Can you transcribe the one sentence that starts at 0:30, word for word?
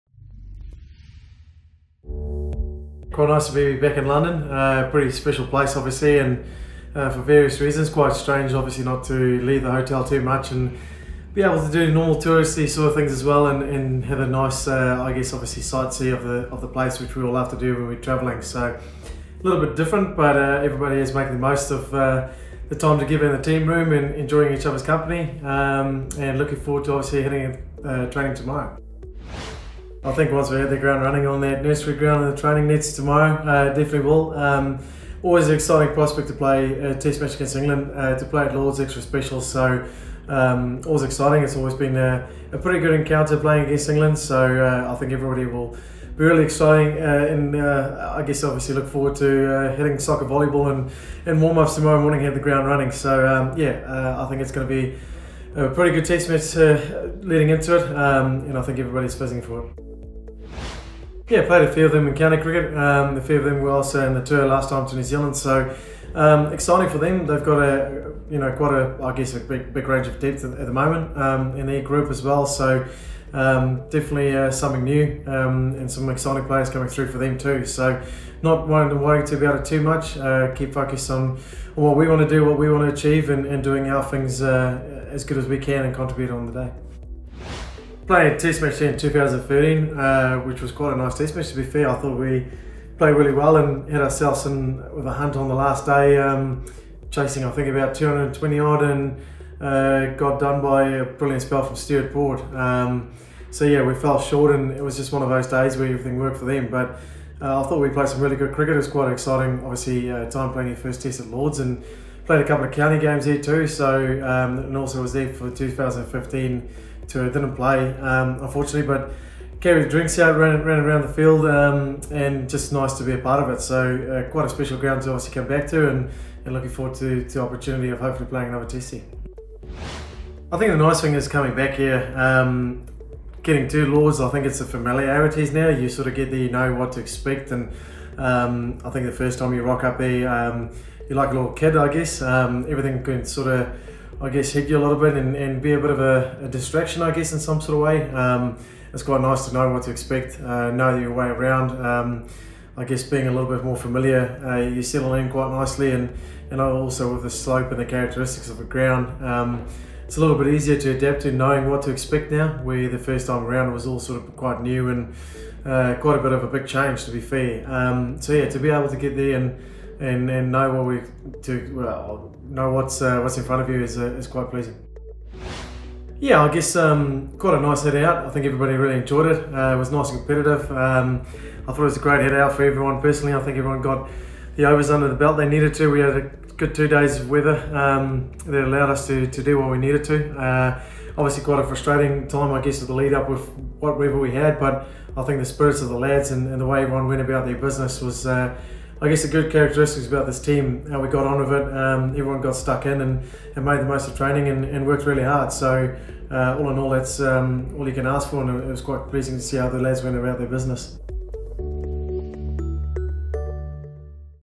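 I think once we hit the ground running on that nursery ground and the training nets tomorrow, uh, definitely will.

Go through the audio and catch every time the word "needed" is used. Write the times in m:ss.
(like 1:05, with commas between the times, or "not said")
3:05, 3:09.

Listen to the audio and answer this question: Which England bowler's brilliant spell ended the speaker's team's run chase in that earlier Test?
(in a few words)
Stuart Broad.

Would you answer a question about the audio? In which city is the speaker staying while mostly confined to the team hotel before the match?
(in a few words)
London.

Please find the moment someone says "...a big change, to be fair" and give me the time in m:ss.
2:46.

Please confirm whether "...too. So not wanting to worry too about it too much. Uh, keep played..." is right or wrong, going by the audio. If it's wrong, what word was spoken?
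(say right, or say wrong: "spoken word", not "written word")
wrong: "focused", not "played".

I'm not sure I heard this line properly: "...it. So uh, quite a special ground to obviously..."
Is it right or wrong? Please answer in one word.
right.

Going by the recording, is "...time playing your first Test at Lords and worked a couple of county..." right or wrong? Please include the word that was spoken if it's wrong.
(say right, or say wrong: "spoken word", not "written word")
wrong: "played", not "worked".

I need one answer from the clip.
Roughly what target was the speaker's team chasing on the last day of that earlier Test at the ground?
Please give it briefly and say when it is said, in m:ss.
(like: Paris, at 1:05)
About 220, at 1:37.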